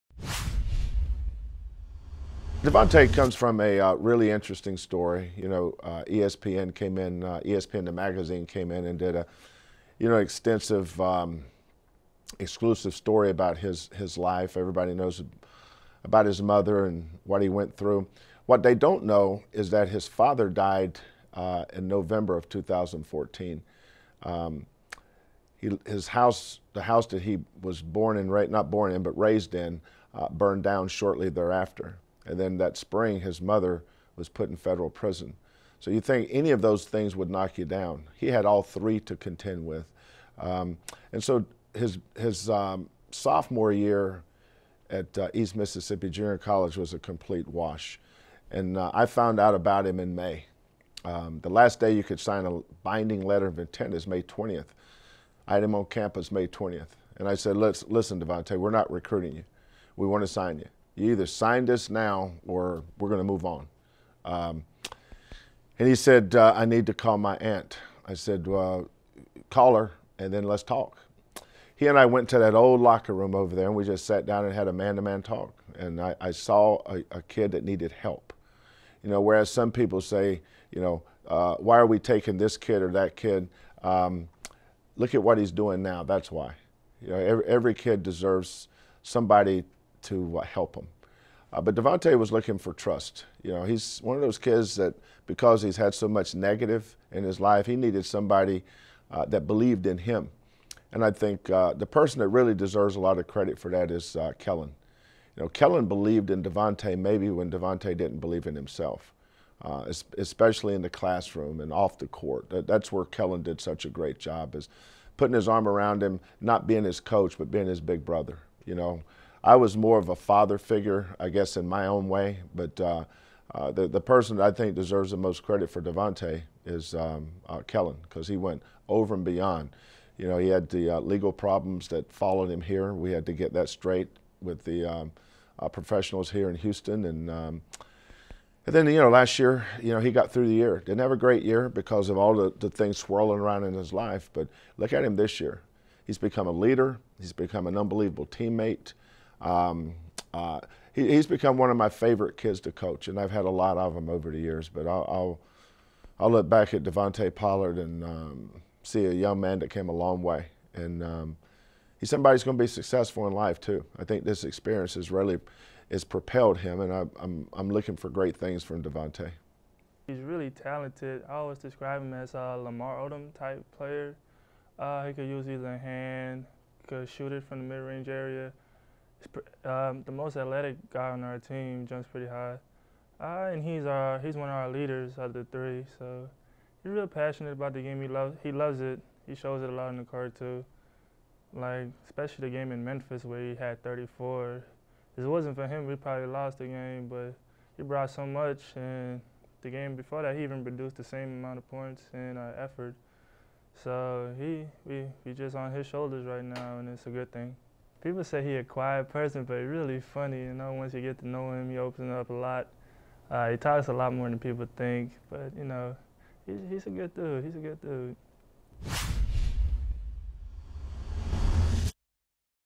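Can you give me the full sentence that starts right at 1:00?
You either signed us now or we're going to move on.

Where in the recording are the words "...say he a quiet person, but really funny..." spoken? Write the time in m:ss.
3:28.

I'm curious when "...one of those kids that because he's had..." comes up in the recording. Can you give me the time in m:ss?
1:34.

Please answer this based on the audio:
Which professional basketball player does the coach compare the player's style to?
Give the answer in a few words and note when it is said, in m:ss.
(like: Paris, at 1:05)
Lamar Odom, at 2:52.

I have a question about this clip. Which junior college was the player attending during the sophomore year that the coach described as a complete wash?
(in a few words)
East Mississippi Junior College.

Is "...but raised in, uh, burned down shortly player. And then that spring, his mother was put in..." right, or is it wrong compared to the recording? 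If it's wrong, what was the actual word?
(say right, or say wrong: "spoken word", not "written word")
wrong: "thereafter", not "player".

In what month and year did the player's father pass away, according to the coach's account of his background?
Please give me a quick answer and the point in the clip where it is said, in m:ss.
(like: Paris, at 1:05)
November 2014, at 0:21.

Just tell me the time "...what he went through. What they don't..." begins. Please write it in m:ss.
0:17.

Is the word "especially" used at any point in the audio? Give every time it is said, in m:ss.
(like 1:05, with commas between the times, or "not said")
1:50, 3:12.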